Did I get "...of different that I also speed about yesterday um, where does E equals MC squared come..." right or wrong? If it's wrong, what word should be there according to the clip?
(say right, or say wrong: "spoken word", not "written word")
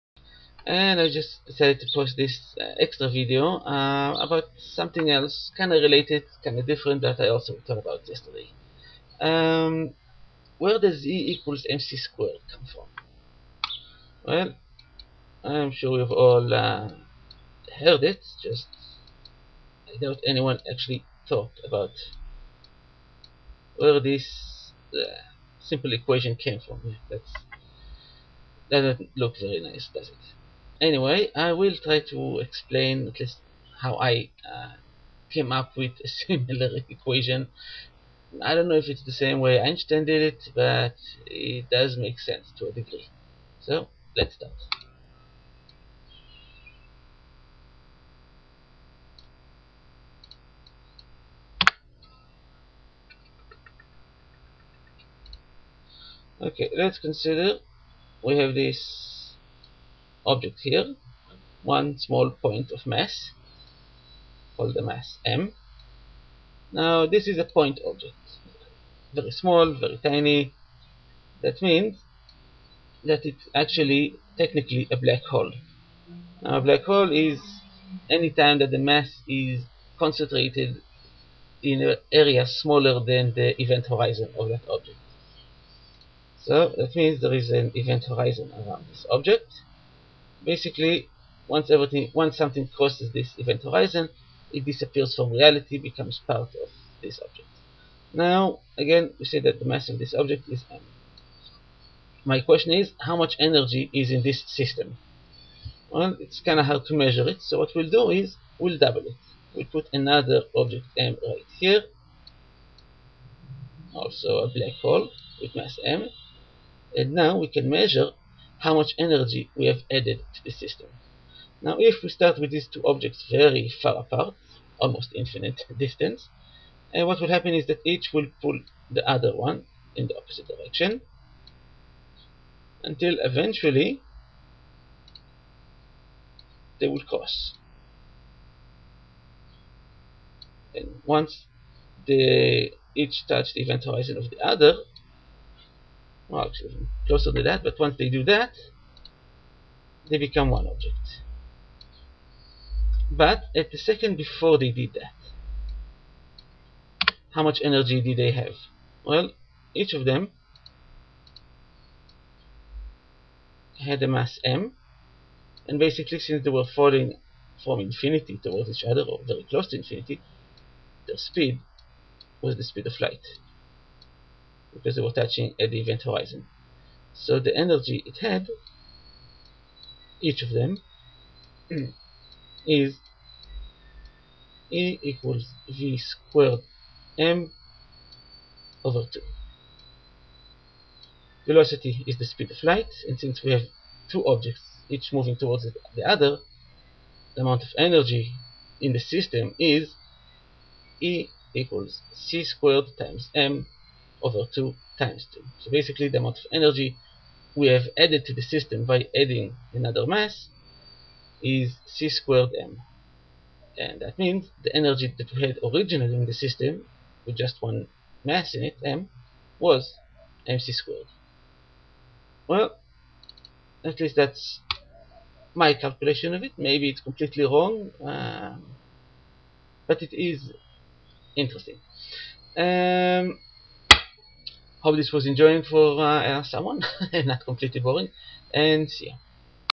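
wrong: "talked", not "speed".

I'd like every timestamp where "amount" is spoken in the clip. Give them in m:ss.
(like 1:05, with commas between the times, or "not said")
3:17, 3:26.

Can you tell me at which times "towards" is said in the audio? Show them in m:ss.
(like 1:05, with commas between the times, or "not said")
2:48, 3:15.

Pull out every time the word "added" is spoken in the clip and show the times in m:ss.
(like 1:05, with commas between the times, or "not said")
1:59, 3:27.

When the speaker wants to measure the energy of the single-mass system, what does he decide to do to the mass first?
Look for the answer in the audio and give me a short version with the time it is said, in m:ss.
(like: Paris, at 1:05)
Double it, at 1:48.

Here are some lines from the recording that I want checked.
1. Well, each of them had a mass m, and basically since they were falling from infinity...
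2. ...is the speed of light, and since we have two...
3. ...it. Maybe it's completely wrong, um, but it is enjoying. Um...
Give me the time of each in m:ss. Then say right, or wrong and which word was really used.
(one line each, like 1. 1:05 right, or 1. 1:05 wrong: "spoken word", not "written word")
1. 2:39 right
2. 3:12 right
3. 3:46 wrong: "interesting", not "enjoying".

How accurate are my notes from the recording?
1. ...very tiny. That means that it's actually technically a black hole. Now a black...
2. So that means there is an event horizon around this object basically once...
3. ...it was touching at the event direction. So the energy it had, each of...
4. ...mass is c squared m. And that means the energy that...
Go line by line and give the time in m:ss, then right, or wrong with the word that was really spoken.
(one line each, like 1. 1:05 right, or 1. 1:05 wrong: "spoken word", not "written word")
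1. 1:09 right
2. 1:26 right
3. 2:54 wrong: "horizon", not "direction"
4. 3:30 right.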